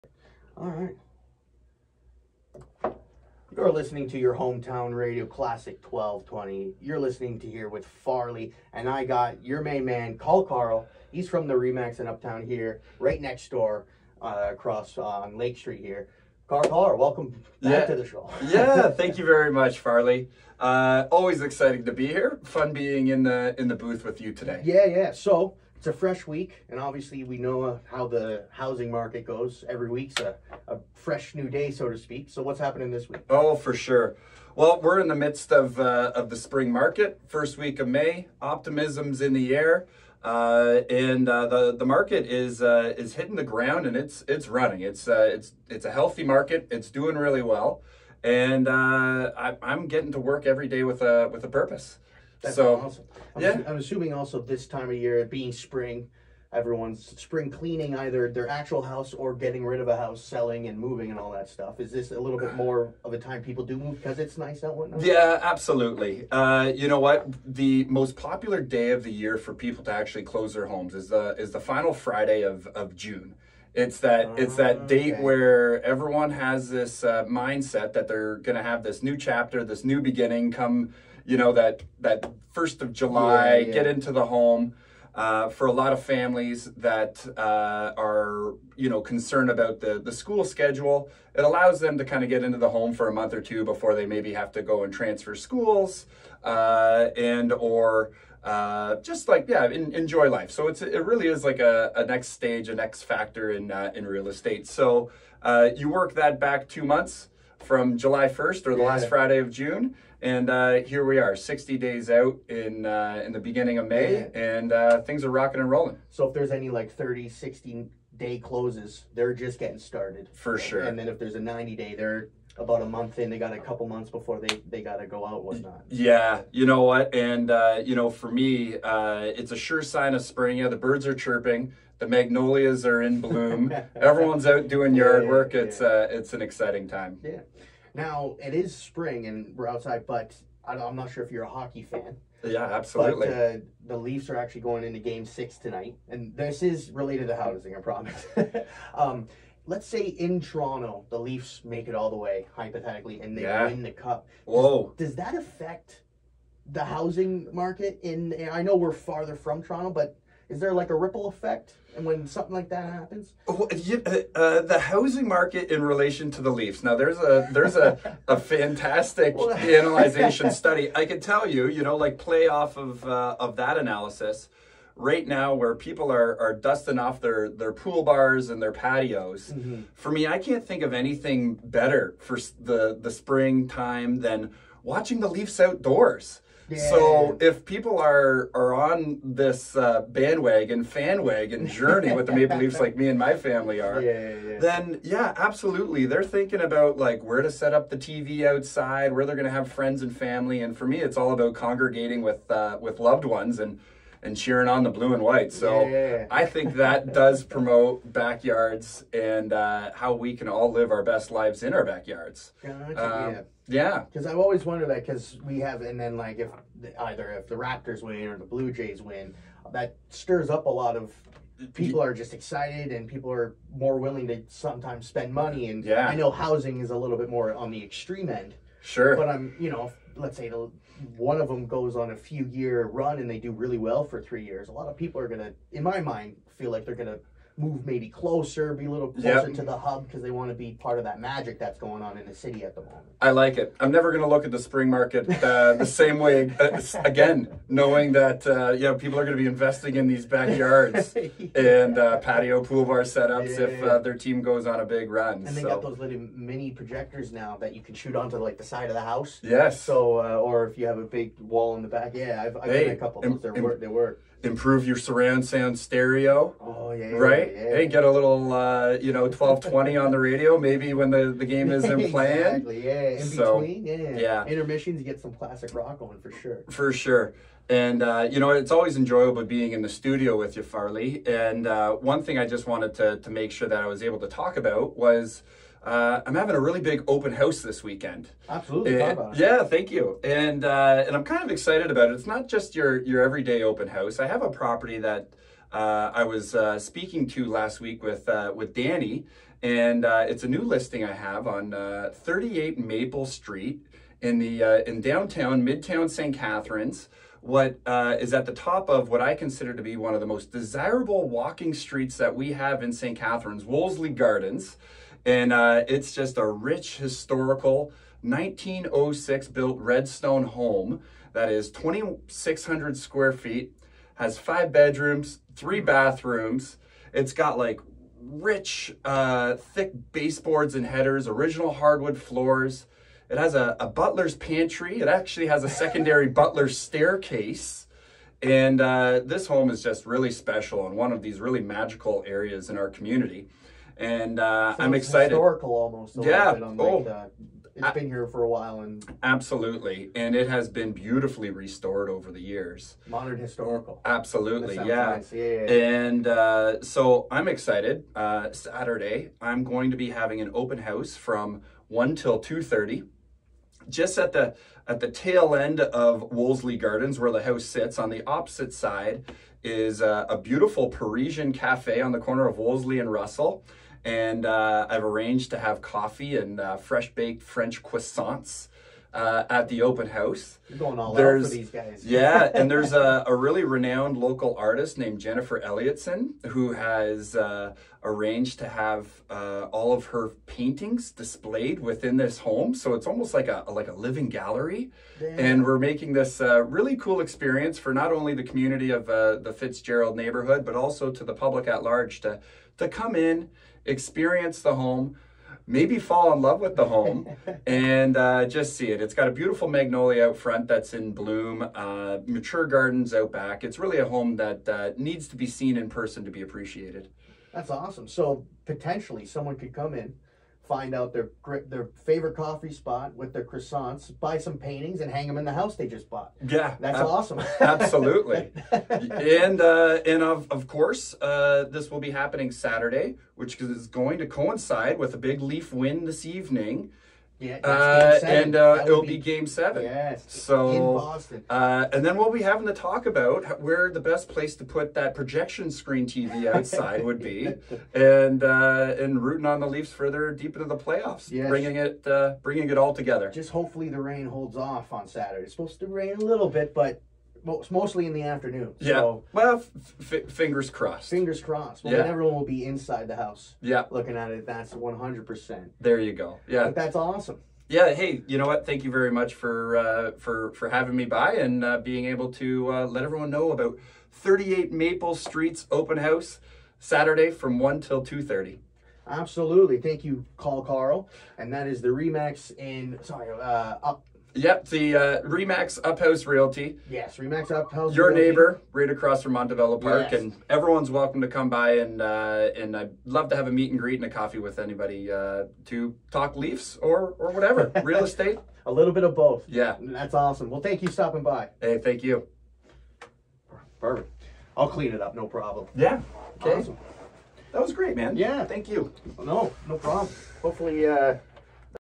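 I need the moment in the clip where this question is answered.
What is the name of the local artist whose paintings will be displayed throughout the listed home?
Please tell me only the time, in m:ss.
6:25.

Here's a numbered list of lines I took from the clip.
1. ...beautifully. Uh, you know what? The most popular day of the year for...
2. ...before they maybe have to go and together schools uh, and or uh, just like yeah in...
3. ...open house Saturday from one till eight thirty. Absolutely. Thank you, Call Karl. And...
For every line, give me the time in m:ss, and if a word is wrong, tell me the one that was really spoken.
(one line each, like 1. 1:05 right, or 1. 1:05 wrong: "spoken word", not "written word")
1. 1:05 wrong: "absolutely", not "beautifully"
2. 1:33 wrong: "transfer", not "together"
3. 7:55 wrong: "two", not "eight".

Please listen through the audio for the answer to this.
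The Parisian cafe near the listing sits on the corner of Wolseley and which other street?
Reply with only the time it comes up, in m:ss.
6:13.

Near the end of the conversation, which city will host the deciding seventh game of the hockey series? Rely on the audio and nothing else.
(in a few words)
Boston.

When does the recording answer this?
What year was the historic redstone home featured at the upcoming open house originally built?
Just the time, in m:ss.
5:18.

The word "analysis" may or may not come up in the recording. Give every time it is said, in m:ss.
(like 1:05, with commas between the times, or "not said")
2:49, 2:53.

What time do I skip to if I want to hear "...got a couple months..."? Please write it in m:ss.
2:03.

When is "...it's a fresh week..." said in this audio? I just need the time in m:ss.
0:25.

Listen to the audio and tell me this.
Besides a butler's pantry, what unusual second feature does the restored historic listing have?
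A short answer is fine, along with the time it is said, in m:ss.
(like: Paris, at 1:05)
Butler's staircase, at 5:36.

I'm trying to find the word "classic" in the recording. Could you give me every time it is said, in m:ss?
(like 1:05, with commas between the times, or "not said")
0:05, 4:35.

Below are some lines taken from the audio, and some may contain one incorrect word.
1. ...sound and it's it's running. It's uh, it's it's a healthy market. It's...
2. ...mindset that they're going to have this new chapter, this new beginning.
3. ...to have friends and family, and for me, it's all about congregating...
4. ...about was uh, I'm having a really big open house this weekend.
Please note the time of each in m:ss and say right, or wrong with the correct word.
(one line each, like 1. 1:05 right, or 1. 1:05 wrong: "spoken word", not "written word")
1. 0:43 wrong: "ground", not "sound"
2. 1:17 right
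3. 3:19 right
4. 4:44 right.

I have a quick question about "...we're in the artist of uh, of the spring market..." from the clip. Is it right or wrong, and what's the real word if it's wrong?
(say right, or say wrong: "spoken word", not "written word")
wrong: "midst", not "artist".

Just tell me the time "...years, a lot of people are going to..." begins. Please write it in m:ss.
3:54.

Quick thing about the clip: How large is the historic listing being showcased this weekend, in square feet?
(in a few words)
2,600 square feet.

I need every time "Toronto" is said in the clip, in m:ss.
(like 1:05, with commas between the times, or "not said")
2:30, 2:39.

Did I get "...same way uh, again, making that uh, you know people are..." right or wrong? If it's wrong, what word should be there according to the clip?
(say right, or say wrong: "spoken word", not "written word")
wrong: "knowing", not "making".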